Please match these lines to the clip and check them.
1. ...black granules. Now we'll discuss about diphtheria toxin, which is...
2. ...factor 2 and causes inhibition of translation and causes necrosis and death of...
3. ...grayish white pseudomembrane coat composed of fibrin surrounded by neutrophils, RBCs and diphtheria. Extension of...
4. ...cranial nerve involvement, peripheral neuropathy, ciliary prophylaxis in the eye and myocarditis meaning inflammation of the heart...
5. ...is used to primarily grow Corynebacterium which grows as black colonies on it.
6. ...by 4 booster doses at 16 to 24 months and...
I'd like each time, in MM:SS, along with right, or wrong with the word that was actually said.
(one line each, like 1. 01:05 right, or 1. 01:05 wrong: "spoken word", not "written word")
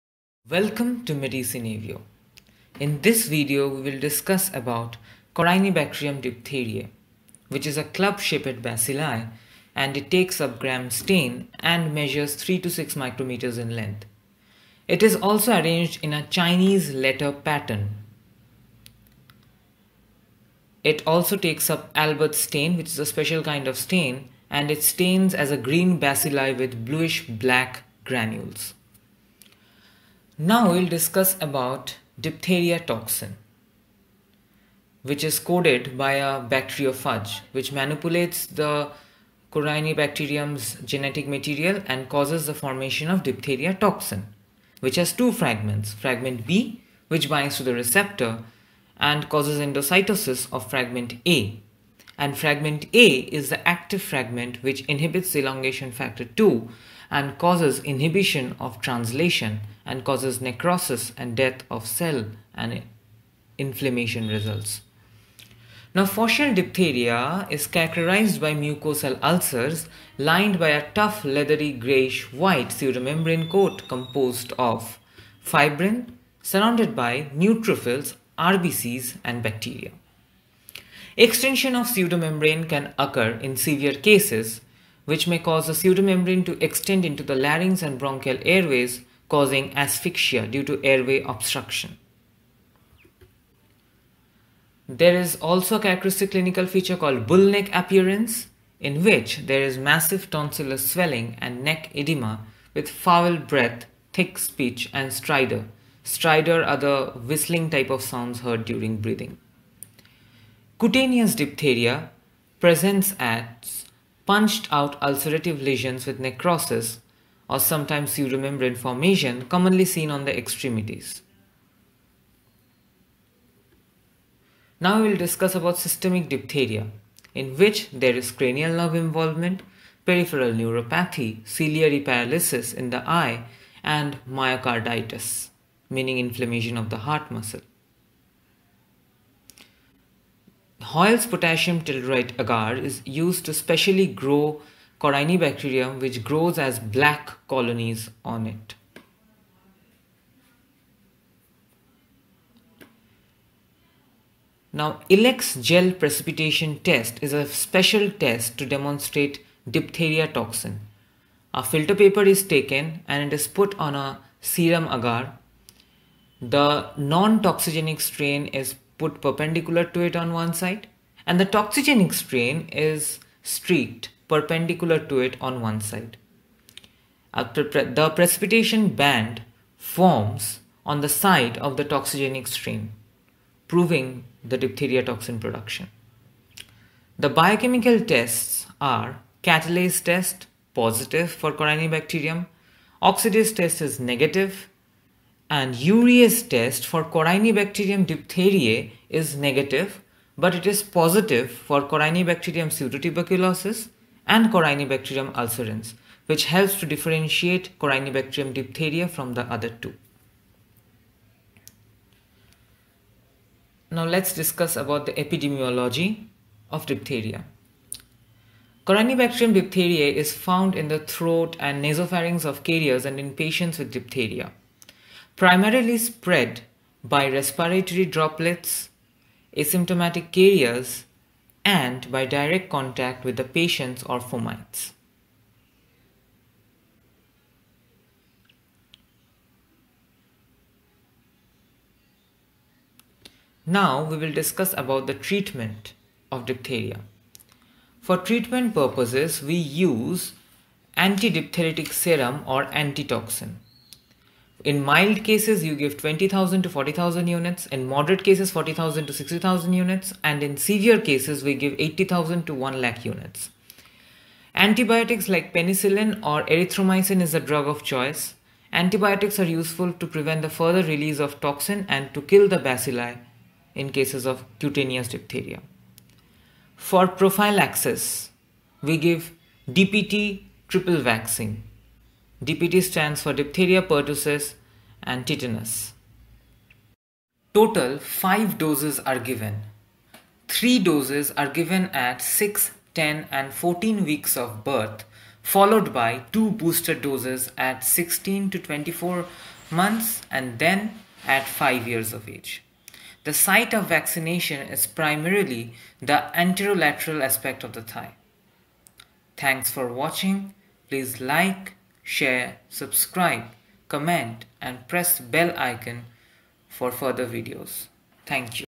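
1. 00:27 right
2. 00:55 right
3. 01:11 wrong: "bacteria", not "diphtheria"
4. 02:08 wrong: "paralysis", not "prophylaxis"
5. 02:22 wrong: "specially", not "primarily"
6. 04:55 wrong: "2", not "4".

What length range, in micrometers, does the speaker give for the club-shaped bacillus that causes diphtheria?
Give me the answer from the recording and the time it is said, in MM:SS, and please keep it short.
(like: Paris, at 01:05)
3 to 6 micrometers, at 00:12.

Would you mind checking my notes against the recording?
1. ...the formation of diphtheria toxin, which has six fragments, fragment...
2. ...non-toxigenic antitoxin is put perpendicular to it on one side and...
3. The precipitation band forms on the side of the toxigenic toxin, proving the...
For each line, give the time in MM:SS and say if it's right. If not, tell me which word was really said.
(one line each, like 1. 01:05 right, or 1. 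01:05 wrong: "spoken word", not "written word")
1. 00:42 wrong: "two", not "six"
2. 02:46 wrong: "strain", not "antitoxin"
3. 02:57 wrong: "strain", not "toxin".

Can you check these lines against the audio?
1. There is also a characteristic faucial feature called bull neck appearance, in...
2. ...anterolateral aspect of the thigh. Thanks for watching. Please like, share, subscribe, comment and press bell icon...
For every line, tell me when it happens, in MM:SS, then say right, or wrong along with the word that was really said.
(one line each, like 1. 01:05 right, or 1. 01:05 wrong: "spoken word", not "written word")
1. 01:34 wrong: "clinical", not "faucial"
2. 05:06 right.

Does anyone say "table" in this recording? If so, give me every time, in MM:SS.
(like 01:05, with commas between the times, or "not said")
not said.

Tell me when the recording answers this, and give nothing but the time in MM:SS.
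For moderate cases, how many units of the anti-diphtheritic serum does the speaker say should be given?
04:18.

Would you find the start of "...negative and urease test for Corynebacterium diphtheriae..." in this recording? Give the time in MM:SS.
03:13.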